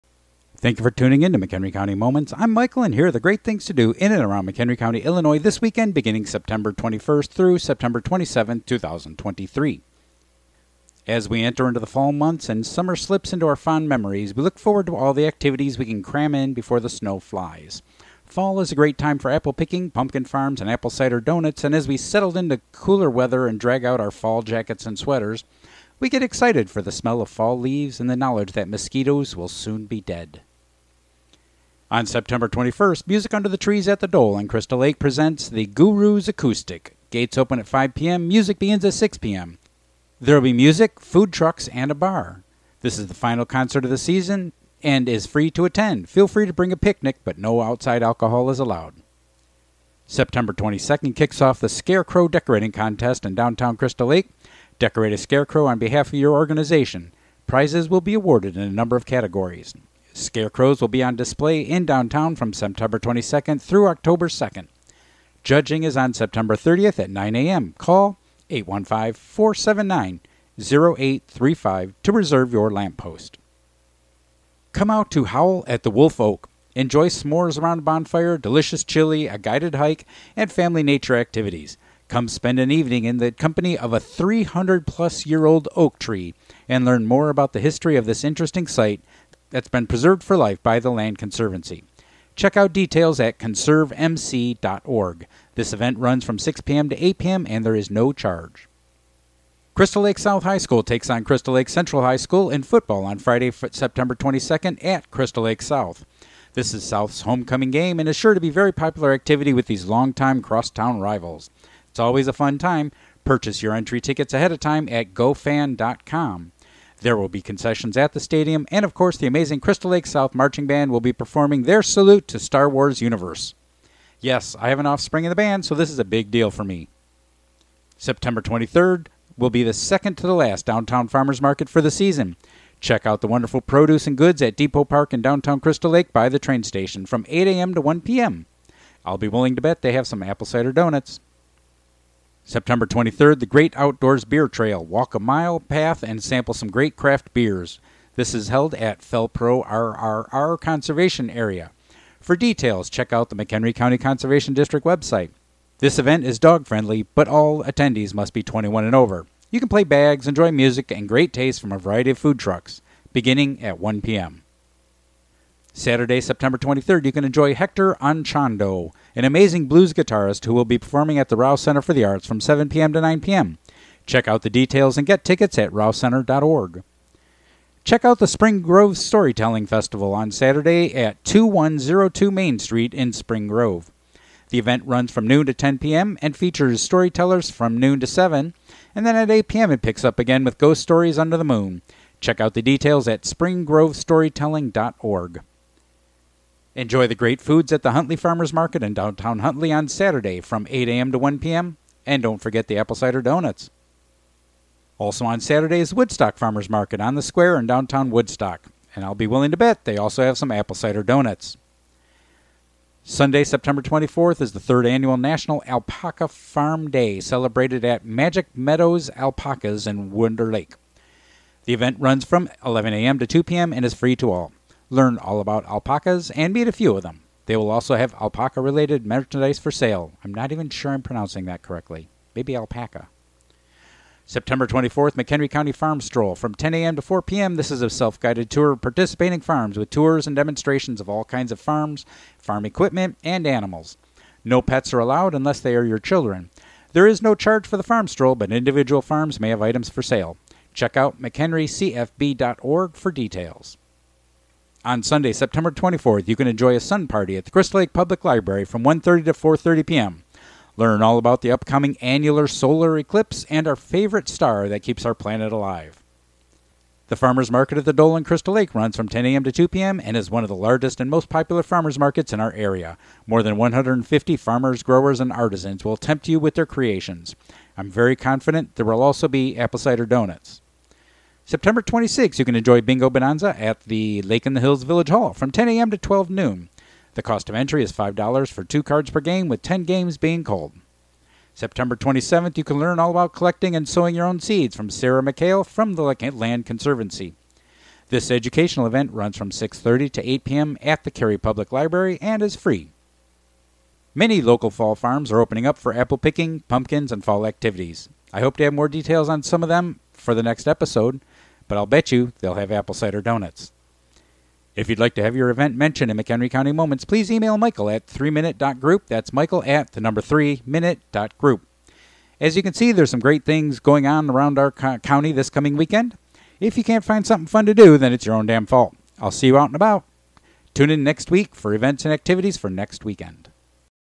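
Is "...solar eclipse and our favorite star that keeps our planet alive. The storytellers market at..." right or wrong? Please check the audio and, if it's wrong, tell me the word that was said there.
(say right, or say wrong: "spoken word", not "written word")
wrong: "farmers", not "storytellers".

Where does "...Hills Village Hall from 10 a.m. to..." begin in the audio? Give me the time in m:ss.
4:44.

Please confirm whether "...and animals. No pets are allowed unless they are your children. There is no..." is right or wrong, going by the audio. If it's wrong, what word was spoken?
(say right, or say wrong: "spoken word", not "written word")
right.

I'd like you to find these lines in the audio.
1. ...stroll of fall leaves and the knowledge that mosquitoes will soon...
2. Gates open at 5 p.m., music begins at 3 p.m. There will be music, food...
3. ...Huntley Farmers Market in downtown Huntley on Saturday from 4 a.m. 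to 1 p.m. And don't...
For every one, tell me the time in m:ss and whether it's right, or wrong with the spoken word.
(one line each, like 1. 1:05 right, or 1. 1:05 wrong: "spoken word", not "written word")
1. 0:26 wrong: "smell", not "stroll"
2. 0:37 wrong: "6", not "3"
3. 3:17 wrong: "8", not "4".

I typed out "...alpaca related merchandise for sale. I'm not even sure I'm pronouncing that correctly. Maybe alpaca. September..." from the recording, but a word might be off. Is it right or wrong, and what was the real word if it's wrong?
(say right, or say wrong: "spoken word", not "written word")
right.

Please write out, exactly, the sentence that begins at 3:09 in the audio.
it picks up again with Ghost Stories Under the Moon.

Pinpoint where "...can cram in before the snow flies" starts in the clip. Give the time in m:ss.
0:15.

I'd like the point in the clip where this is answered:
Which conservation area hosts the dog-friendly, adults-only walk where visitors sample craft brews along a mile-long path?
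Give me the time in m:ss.
2:28.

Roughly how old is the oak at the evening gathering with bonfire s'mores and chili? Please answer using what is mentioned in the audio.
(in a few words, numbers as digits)
300 plus years.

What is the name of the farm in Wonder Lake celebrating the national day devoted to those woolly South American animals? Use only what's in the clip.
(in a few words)
Magic Meadows Alpacas.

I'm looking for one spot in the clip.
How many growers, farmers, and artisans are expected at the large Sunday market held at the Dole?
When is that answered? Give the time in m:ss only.
4:33.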